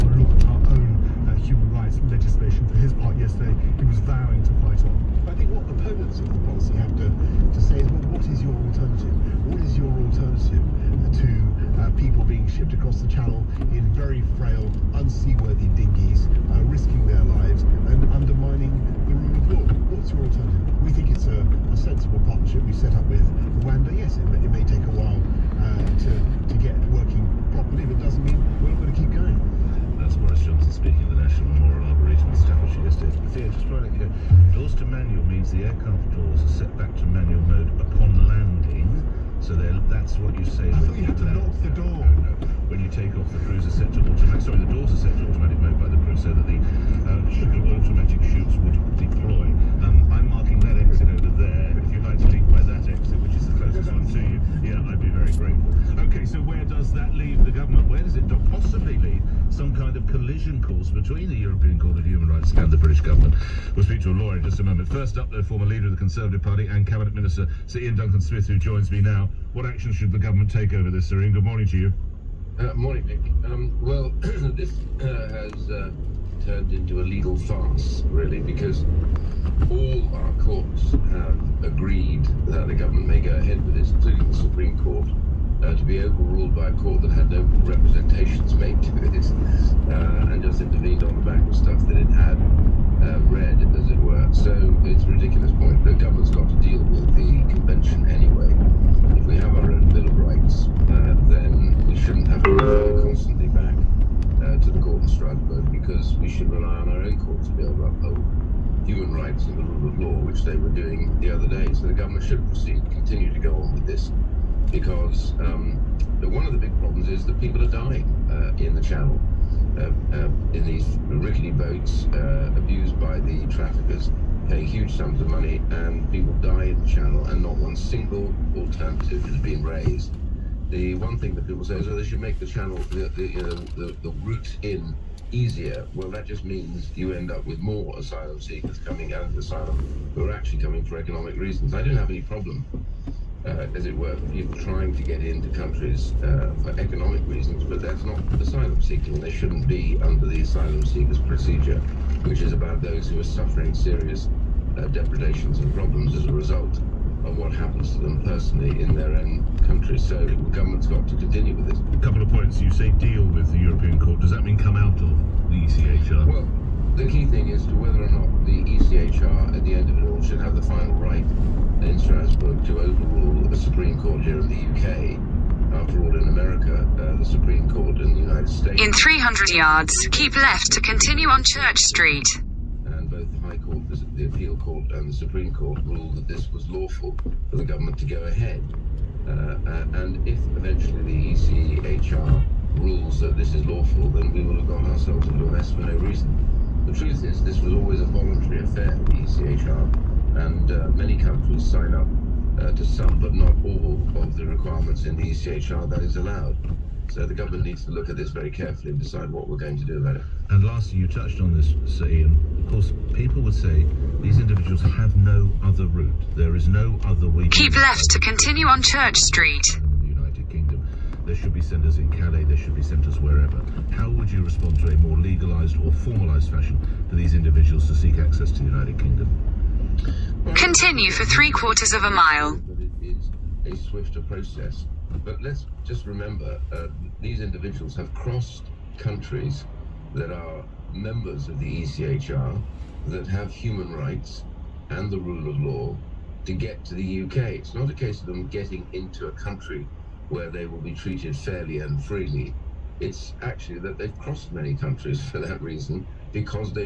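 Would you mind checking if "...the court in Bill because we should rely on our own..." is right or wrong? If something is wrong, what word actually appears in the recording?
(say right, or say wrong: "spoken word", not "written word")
wrong: "Strasbourg", not "Bill".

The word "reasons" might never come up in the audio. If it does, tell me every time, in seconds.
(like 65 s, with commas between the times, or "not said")
141 s, 147 s, 195 s, 255 s.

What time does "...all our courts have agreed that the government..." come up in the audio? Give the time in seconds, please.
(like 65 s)
79 s.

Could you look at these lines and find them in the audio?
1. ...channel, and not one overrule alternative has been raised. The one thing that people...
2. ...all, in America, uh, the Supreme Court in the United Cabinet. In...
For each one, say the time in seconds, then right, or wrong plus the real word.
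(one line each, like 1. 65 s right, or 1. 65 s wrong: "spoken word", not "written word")
1. 126 s wrong: "single", not "overrule"
2. 176 s wrong: "States", not "Cabinet".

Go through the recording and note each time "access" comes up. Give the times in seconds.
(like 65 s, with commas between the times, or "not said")
228 s.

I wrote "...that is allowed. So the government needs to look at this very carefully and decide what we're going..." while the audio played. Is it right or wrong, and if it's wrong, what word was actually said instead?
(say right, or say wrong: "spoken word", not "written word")
right.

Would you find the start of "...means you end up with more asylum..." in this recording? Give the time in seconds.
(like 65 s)
136 s.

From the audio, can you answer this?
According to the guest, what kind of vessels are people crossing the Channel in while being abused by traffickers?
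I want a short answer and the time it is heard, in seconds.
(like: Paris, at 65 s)
rickety boats, at 121 s.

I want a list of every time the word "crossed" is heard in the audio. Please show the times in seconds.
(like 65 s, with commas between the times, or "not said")
238 s, 254 s.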